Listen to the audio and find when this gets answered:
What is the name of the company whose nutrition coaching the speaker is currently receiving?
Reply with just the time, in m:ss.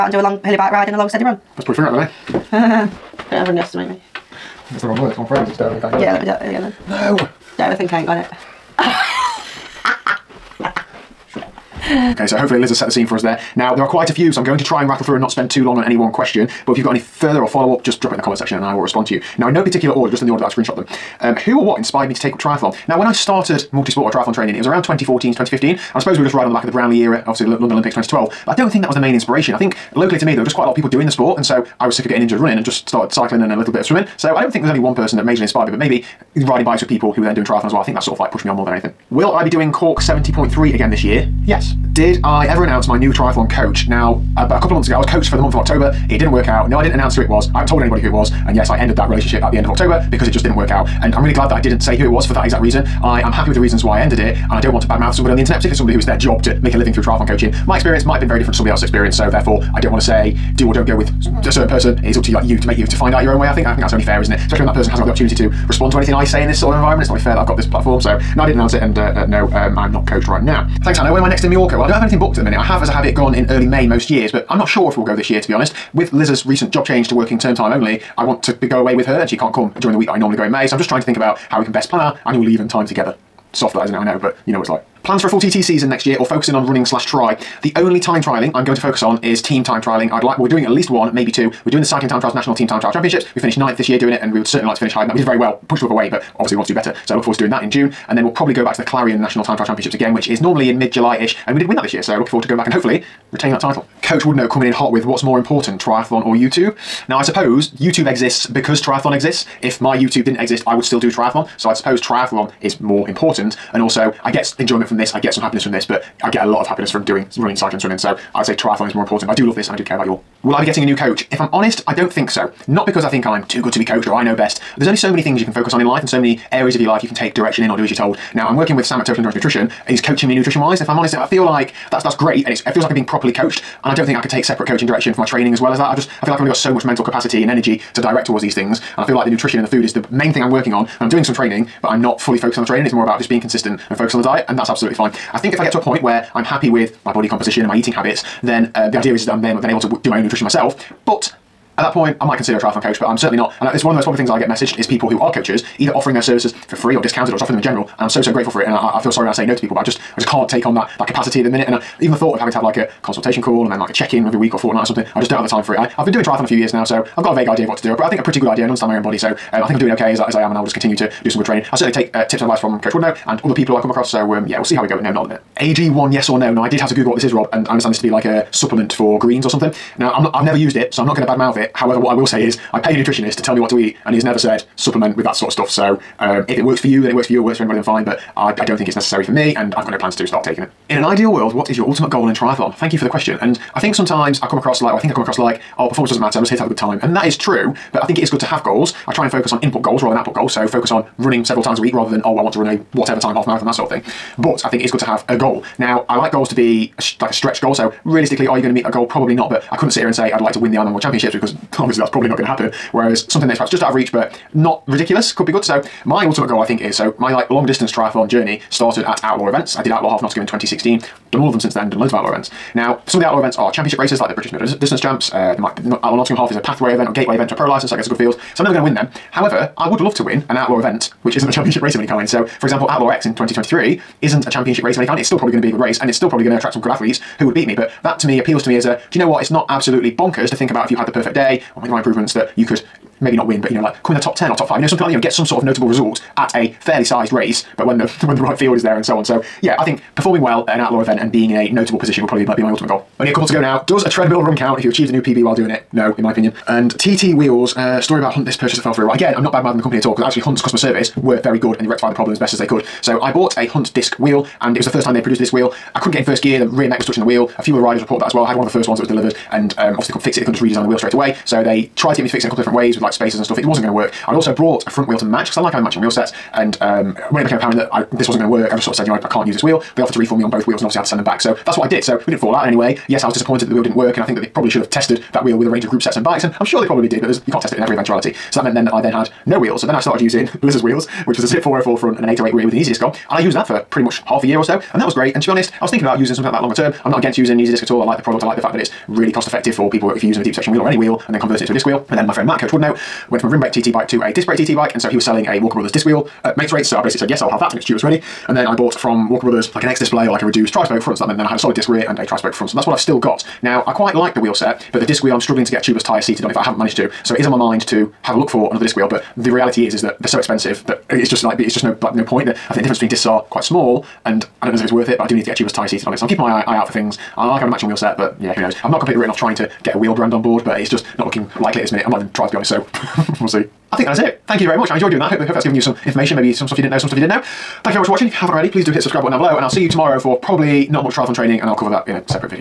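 2:09.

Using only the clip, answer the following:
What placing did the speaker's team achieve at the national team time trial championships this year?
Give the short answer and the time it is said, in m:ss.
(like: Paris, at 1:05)
Ninth, at 1:33.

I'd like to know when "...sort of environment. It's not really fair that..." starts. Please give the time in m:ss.
1:06.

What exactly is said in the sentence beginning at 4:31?
So they tried to get me to fix it in a couple of different ways with like spacers and stuff.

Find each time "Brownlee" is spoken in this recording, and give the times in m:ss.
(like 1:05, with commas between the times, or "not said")
0:26.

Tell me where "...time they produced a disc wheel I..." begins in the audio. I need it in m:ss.
4:25.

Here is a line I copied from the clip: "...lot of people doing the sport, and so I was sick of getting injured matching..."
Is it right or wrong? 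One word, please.
wrong.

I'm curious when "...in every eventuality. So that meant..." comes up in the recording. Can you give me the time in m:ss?
4:47.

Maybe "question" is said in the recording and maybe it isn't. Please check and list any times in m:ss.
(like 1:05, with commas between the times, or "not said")
0:16, 3:13.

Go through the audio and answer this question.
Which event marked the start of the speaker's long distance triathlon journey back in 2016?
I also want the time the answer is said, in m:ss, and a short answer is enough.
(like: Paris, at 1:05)
Outlaw Half Nottingham, at 3:39.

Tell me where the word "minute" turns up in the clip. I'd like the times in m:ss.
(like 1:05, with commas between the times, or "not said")
1:12, 2:41, 2:55, 5:31.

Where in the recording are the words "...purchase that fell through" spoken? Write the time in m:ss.
4:18.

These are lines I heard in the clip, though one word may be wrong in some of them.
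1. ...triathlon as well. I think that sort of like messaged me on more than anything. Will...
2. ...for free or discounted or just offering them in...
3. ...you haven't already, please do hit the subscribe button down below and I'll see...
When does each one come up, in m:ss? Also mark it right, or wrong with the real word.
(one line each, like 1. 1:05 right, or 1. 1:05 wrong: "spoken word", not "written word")
1. 0:37 wrong: "pushed", not "messaged"
2. 2:36 right
3. 5:38 right.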